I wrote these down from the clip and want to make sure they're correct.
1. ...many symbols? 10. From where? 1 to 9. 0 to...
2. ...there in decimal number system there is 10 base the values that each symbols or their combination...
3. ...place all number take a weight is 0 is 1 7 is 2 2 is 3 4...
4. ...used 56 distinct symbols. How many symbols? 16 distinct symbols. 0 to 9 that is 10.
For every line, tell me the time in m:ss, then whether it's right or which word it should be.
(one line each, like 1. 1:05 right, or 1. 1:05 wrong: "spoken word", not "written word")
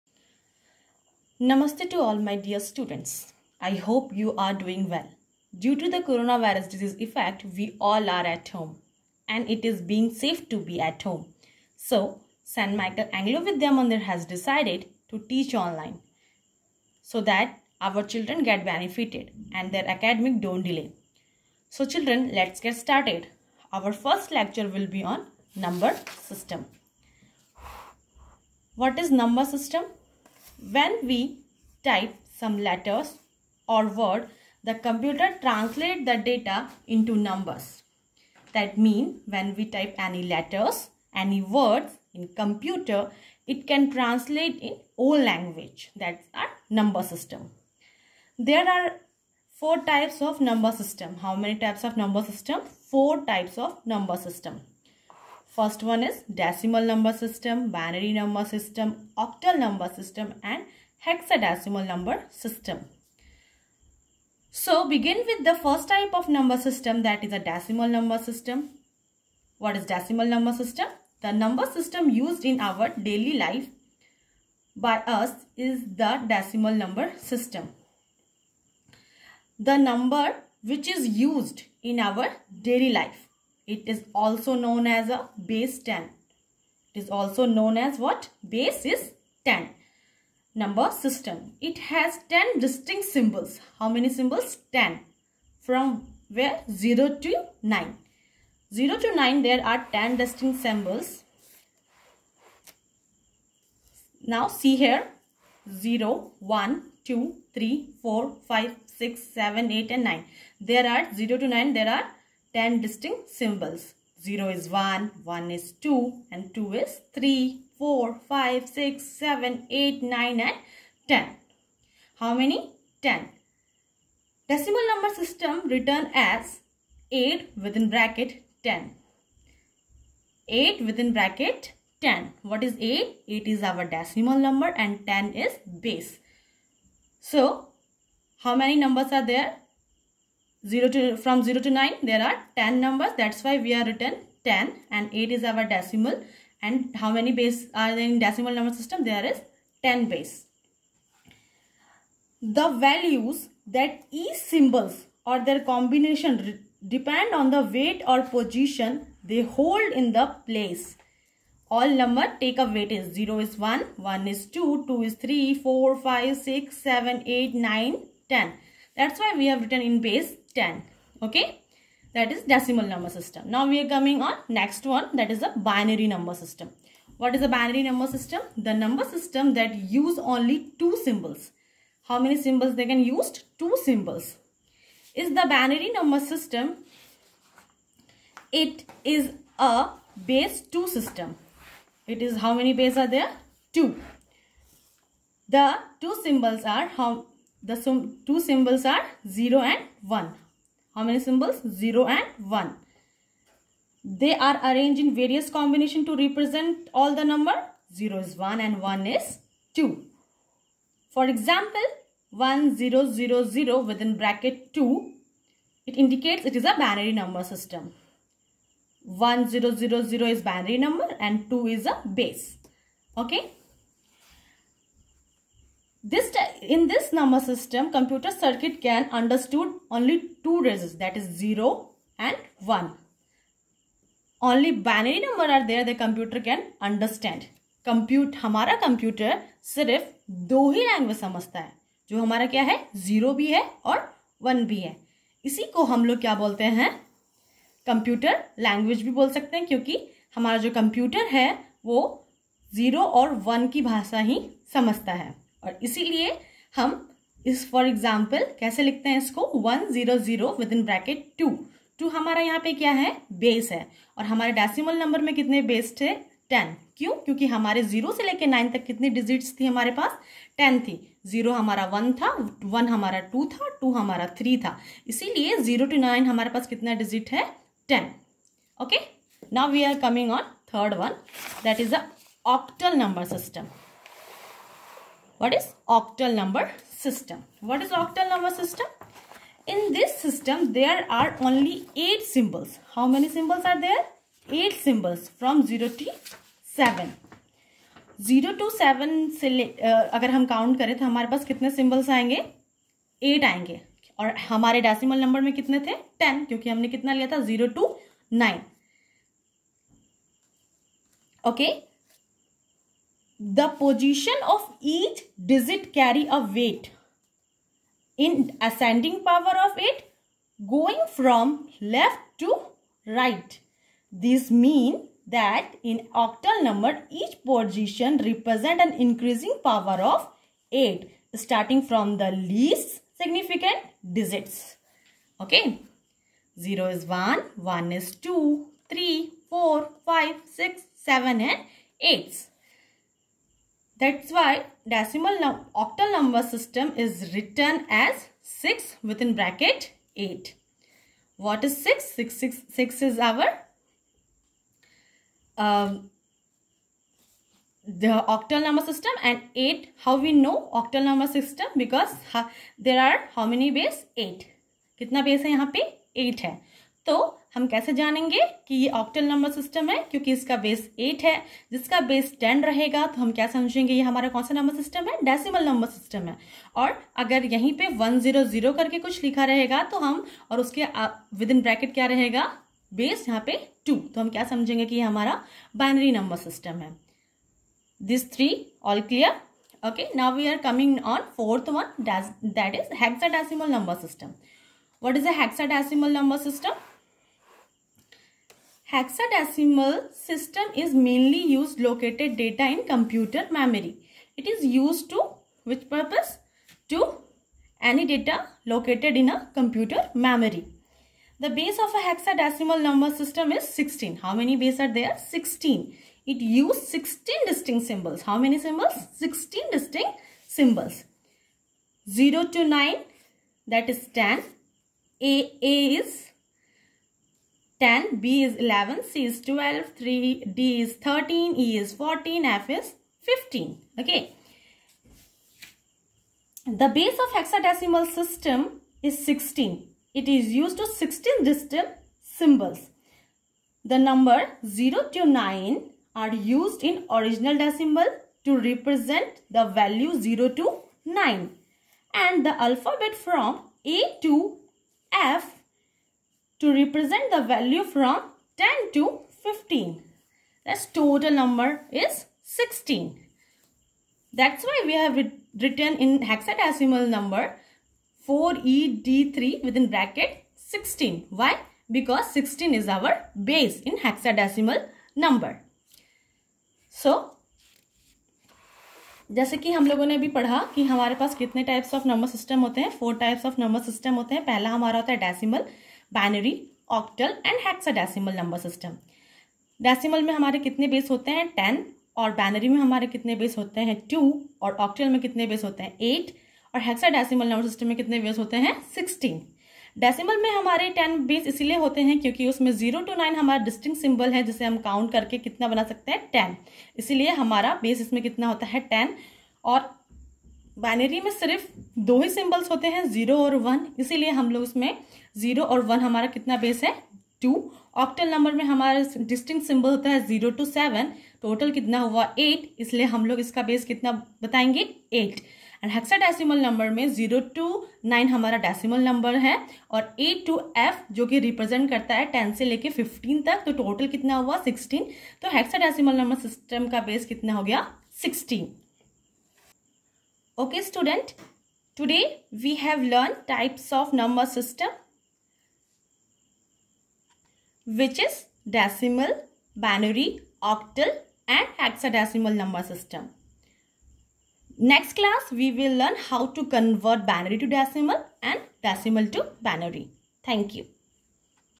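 1. 1:33 wrong: "0", not "1"
2. 2:27 right
3. 2:40 wrong: "1", not "7"
4. 6:56 wrong: "16", not "56".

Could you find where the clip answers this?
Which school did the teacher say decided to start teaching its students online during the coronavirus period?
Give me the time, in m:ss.
0:12.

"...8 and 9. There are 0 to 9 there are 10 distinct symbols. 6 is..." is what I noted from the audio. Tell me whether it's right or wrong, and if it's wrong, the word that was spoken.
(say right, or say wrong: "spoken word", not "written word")
wrong: "0", not "6".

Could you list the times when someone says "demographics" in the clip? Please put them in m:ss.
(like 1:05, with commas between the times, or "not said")
not said.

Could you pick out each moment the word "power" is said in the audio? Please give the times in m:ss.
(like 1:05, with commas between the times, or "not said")
5:19, 5:29.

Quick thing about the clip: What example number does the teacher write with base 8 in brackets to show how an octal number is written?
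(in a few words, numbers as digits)
6.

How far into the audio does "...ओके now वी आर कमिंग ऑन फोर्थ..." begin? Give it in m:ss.
6:29.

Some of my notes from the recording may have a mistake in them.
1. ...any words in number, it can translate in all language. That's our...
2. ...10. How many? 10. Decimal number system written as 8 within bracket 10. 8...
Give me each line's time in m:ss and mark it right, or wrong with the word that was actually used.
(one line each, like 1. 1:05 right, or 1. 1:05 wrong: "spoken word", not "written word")
1. 0:41 wrong: "computer", not "number"
2. 2:01 right.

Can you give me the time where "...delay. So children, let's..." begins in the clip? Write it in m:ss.
0:20.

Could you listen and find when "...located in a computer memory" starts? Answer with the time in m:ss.
6:48.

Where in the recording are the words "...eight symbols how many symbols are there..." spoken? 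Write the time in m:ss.
4:52.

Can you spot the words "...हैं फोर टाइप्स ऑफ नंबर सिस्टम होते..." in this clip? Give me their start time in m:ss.
8:02.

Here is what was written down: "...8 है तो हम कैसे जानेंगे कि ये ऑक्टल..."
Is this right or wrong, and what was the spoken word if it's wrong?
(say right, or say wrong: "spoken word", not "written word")
right.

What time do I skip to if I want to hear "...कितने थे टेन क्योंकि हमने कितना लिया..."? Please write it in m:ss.
5:05.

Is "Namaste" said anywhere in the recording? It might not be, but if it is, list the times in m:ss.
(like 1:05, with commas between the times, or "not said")
0:01.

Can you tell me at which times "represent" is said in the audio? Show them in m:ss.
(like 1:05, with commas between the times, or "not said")
3:26, 5:28, 7:28, 7:36.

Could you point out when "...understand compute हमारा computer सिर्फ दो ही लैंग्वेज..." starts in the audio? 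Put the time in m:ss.
3:56.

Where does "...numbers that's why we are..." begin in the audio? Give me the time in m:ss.
2:22.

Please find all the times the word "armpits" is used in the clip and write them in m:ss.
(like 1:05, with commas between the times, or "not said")
not said.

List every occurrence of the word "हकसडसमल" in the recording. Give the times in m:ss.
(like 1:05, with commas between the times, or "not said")
8:07, 8:16.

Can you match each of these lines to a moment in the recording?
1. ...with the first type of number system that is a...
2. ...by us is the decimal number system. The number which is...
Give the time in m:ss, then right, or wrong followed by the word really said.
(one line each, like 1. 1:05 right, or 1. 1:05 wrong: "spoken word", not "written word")
1. 1:05 right
2. 1:14 right.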